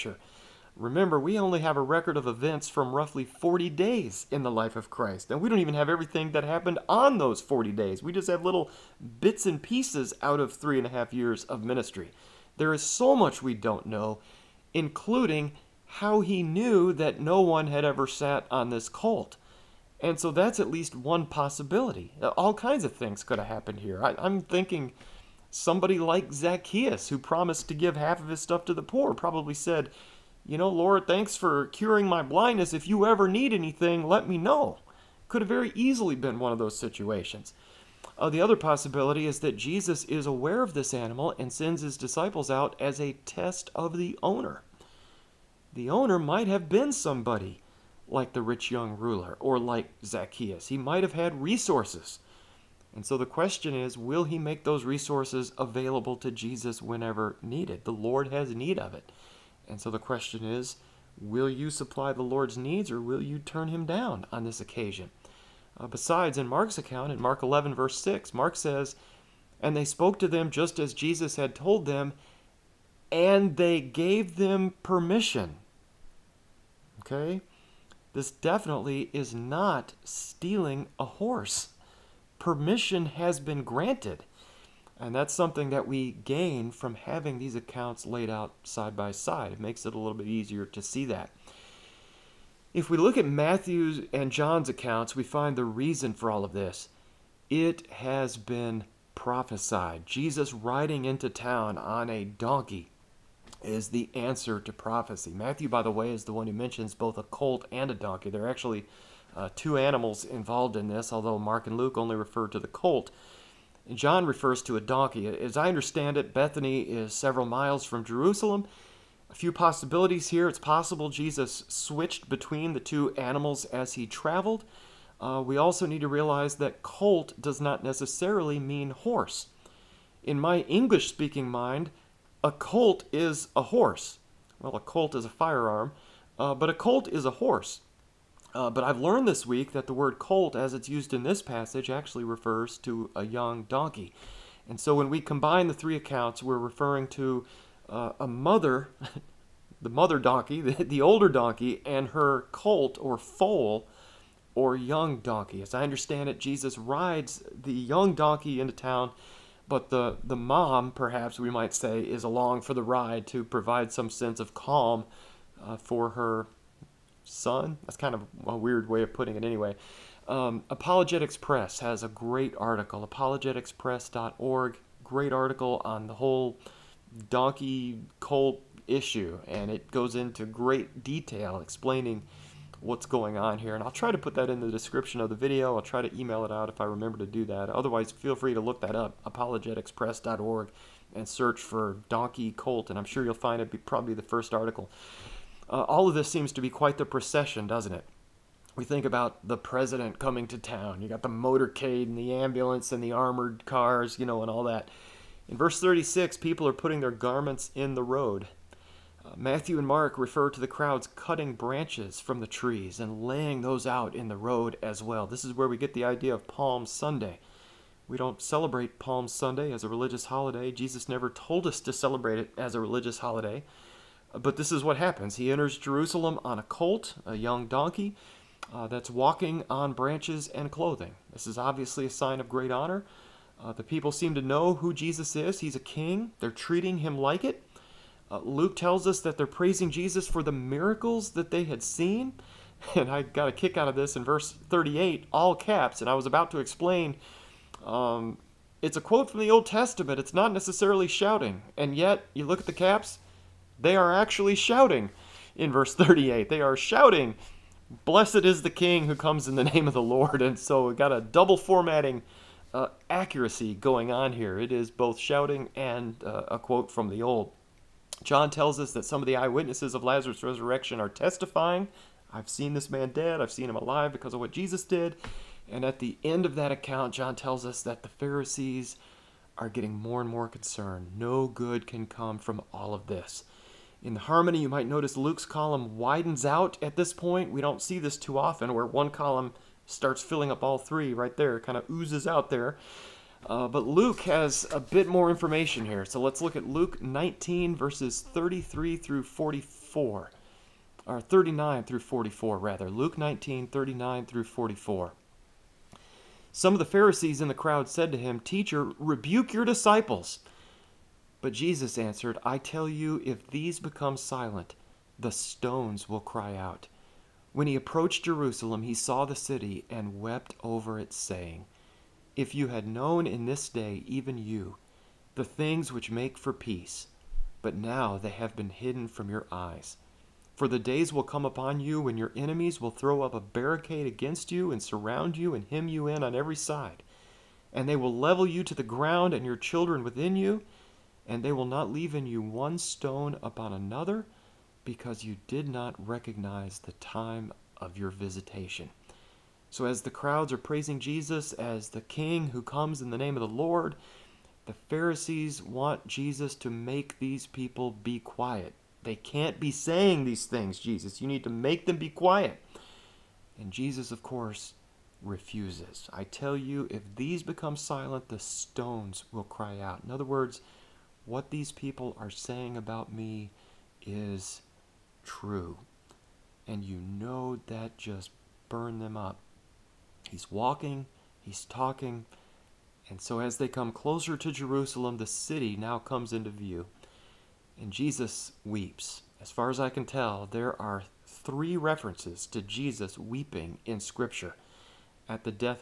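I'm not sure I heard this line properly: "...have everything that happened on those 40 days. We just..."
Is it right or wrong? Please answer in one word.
right.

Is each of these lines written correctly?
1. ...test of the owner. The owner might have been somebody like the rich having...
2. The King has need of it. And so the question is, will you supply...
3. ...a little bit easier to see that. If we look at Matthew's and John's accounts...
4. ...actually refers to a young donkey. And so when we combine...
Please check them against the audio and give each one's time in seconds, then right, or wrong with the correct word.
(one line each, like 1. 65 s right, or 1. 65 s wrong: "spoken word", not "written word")
1. 43 s wrong: "young", not "having"
2. 57 s wrong: "Lord", not "King"
3. 89 s right
4. 141 s right.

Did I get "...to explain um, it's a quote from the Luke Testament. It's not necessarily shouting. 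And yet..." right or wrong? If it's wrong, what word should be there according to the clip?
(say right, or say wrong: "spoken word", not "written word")
wrong: "Old", not "Luke".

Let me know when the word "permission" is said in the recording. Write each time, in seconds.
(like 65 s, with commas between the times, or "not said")
74 s, 82 s.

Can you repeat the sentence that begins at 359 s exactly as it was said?
They can't be saying these things, Jesus.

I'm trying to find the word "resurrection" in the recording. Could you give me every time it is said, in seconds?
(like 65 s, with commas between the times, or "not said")
270 s.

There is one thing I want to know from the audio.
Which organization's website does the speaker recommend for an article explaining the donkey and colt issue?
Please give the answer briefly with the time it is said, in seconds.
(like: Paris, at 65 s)
Apologetics Press, at 170 s.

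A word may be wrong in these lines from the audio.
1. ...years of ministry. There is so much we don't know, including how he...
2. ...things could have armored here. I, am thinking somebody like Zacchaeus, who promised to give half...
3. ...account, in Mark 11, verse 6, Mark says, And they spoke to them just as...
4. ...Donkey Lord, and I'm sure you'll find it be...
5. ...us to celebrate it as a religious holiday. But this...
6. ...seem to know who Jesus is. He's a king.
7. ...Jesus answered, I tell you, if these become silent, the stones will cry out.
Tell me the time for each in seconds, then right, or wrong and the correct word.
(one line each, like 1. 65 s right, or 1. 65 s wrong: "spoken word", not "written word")
1. 11 s right
2. 22 s wrong: "happened", not "armored"
3. 66 s right
4. 192 s wrong: "Colt", not "Lord"
5. 221 s right
6. 234 s right
7. 311 s right.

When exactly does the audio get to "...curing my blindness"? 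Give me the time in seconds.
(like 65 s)
31 s.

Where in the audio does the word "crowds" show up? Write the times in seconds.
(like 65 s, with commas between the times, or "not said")
210 s, 307 s, 350 s.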